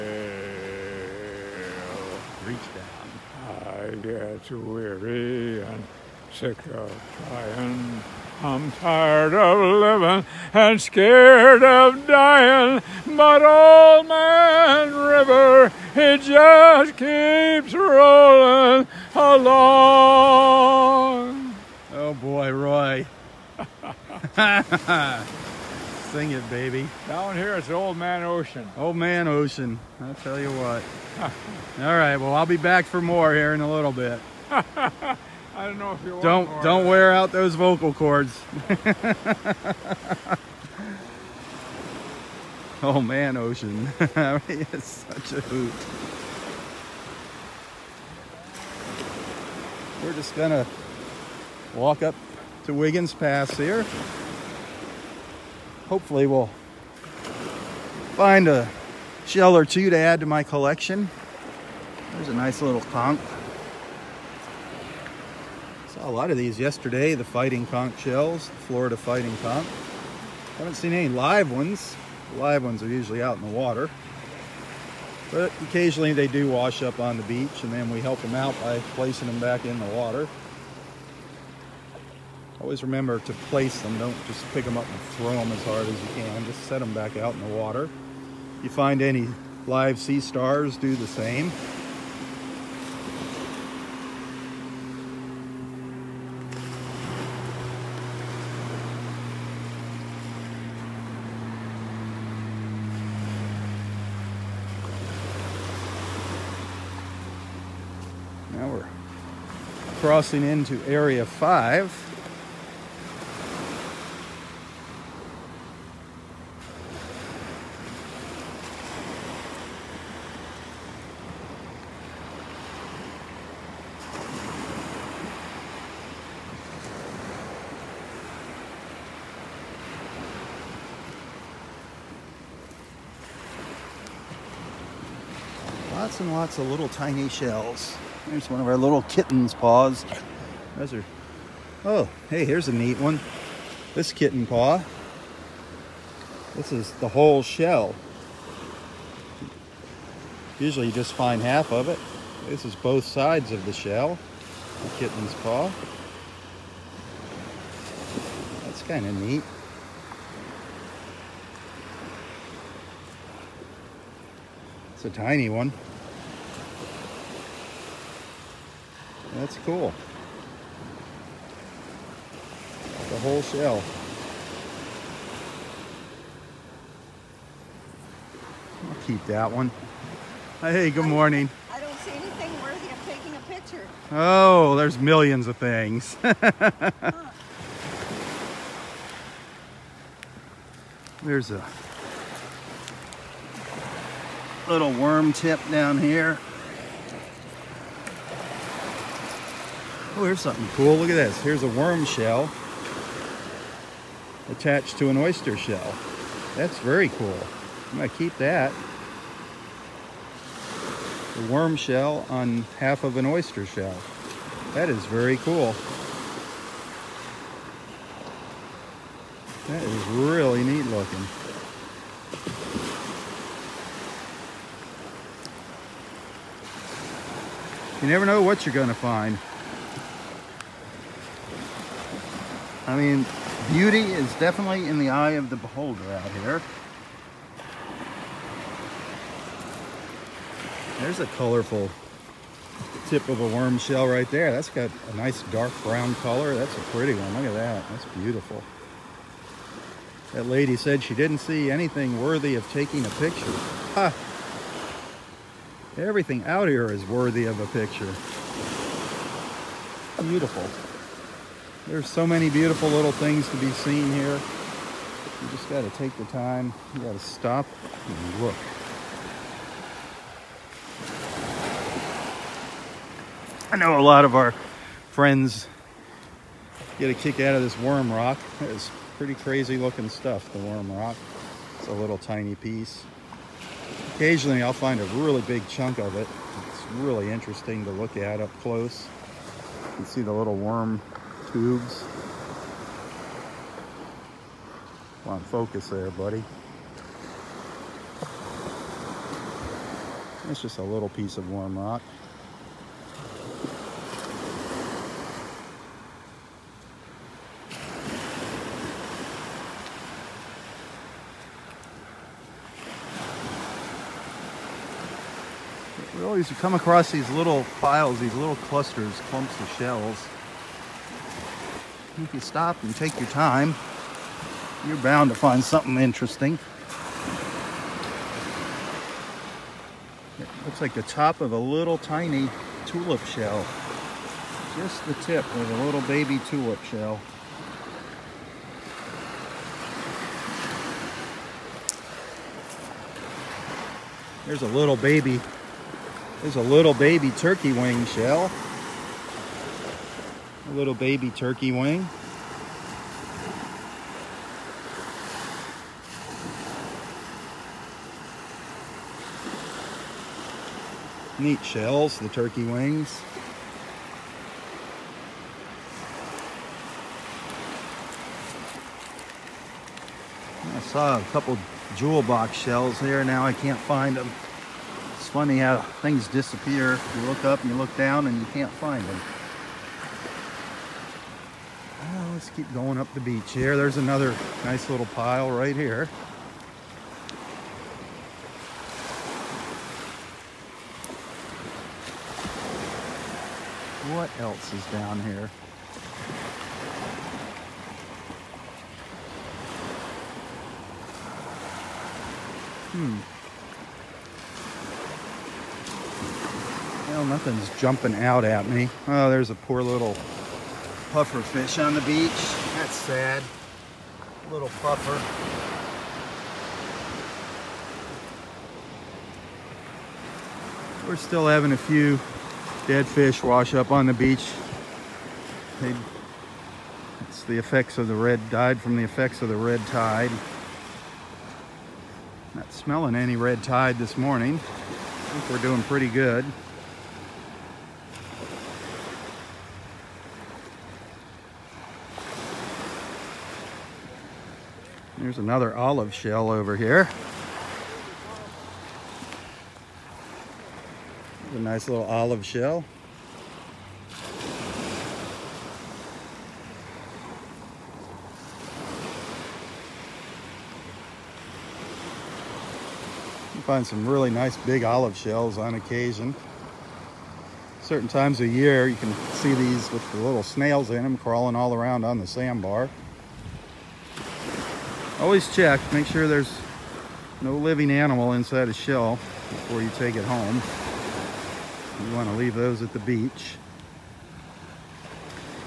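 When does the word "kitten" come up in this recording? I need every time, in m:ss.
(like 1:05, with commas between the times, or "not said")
2:19, 2:24, 2:34.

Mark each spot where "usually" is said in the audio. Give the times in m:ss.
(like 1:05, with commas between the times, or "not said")
1:12, 2:30.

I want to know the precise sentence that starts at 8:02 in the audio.
You want to leave those at the beach.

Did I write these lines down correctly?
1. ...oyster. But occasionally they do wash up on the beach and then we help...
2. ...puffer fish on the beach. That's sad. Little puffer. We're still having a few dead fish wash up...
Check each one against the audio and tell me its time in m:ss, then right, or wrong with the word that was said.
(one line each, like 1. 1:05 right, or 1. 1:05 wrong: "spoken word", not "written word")
1. 1:13 wrong: "water", not "oyster"
2. 6:51 right.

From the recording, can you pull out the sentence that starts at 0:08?
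I'm tired of living and scared of dying.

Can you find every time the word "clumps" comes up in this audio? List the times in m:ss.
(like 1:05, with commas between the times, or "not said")
5:19.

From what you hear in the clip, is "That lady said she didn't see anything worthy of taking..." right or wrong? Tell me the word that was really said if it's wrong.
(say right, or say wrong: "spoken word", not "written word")
right.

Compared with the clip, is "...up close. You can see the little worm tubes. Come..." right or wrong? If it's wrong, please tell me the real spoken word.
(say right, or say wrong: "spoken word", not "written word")
right.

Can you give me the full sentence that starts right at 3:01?
I don't see anything worthy of taking a picture.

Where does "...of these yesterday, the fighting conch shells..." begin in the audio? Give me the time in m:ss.
1:06.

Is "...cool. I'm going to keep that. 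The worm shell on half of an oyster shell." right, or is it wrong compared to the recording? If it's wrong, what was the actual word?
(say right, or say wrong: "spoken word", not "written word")
right.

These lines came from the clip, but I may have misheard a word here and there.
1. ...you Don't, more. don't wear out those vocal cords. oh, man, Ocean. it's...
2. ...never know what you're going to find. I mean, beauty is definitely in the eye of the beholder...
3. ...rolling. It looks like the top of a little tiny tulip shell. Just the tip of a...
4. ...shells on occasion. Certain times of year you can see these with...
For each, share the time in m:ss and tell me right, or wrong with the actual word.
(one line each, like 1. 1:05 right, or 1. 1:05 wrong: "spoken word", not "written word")
1. 0:36 right
2. 3:48 right
3. 5:25 wrong: "interesting", not "rolling"
4. 7:45 right.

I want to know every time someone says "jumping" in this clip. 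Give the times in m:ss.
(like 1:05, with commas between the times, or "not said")
6:47.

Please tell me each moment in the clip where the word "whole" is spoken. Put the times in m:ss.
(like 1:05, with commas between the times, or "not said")
2:27, 2:53.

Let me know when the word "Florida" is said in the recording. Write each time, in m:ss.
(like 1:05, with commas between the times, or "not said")
1:08.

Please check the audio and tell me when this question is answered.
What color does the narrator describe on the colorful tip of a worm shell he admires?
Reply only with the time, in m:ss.
4:05.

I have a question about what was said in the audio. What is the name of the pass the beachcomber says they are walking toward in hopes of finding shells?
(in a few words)
Wiggins Pass.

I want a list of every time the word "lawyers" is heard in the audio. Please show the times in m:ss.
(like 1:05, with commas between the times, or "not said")
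not said.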